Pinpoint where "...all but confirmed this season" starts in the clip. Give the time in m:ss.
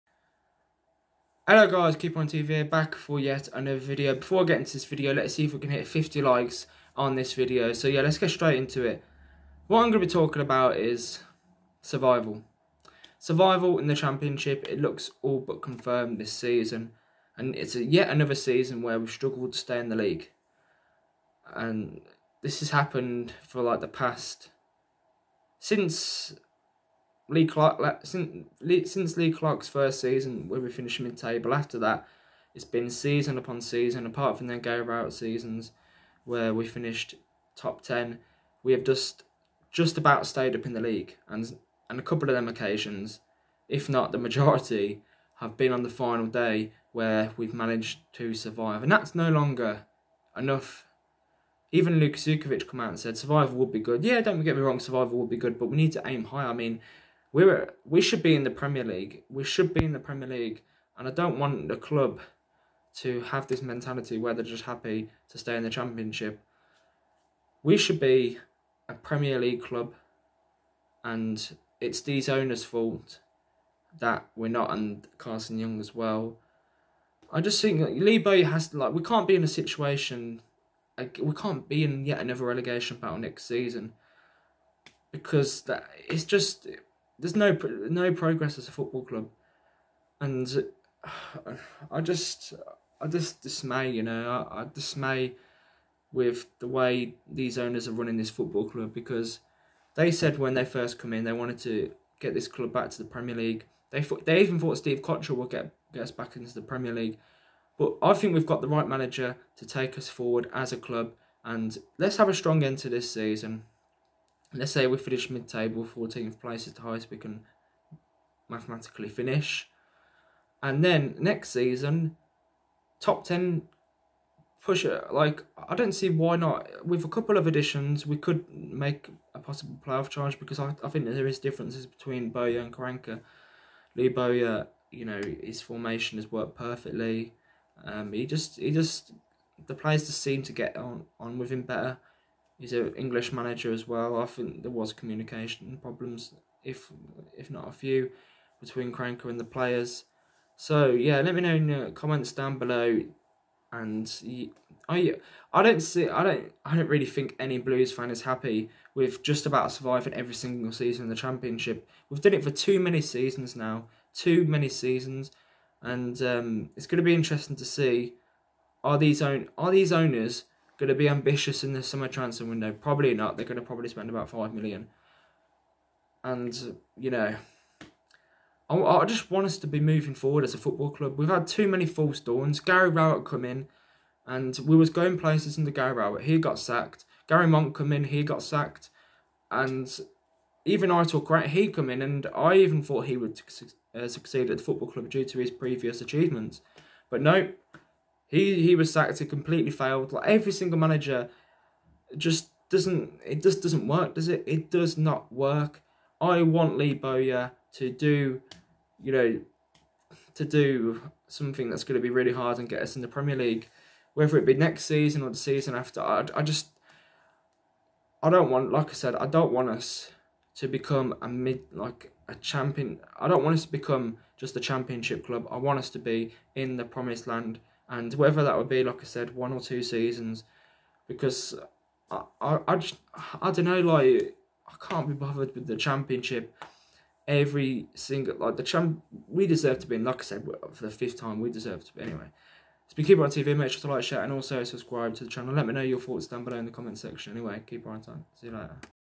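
0:15.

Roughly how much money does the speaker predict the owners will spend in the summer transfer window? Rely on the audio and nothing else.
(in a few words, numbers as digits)
5 million.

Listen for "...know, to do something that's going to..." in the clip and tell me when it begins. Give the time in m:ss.
3:29.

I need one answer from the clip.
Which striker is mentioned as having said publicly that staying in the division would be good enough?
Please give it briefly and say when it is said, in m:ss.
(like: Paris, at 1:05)
Lukas Jutkiewicz, at 0:52.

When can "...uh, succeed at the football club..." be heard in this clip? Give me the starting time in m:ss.
3:13.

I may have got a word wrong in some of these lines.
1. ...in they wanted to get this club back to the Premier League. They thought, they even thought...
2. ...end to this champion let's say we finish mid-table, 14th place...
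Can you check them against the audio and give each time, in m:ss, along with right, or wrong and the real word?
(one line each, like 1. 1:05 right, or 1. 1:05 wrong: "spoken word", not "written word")
1. 1:41 right
2. 1:52 wrong: "season", not "champion".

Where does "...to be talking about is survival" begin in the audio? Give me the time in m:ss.
0:09.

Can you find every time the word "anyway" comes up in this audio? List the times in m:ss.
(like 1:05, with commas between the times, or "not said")
4:02, 4:07.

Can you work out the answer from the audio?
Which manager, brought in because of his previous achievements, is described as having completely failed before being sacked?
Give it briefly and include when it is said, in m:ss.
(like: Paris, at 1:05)
Aitor Karanka, at 3:10.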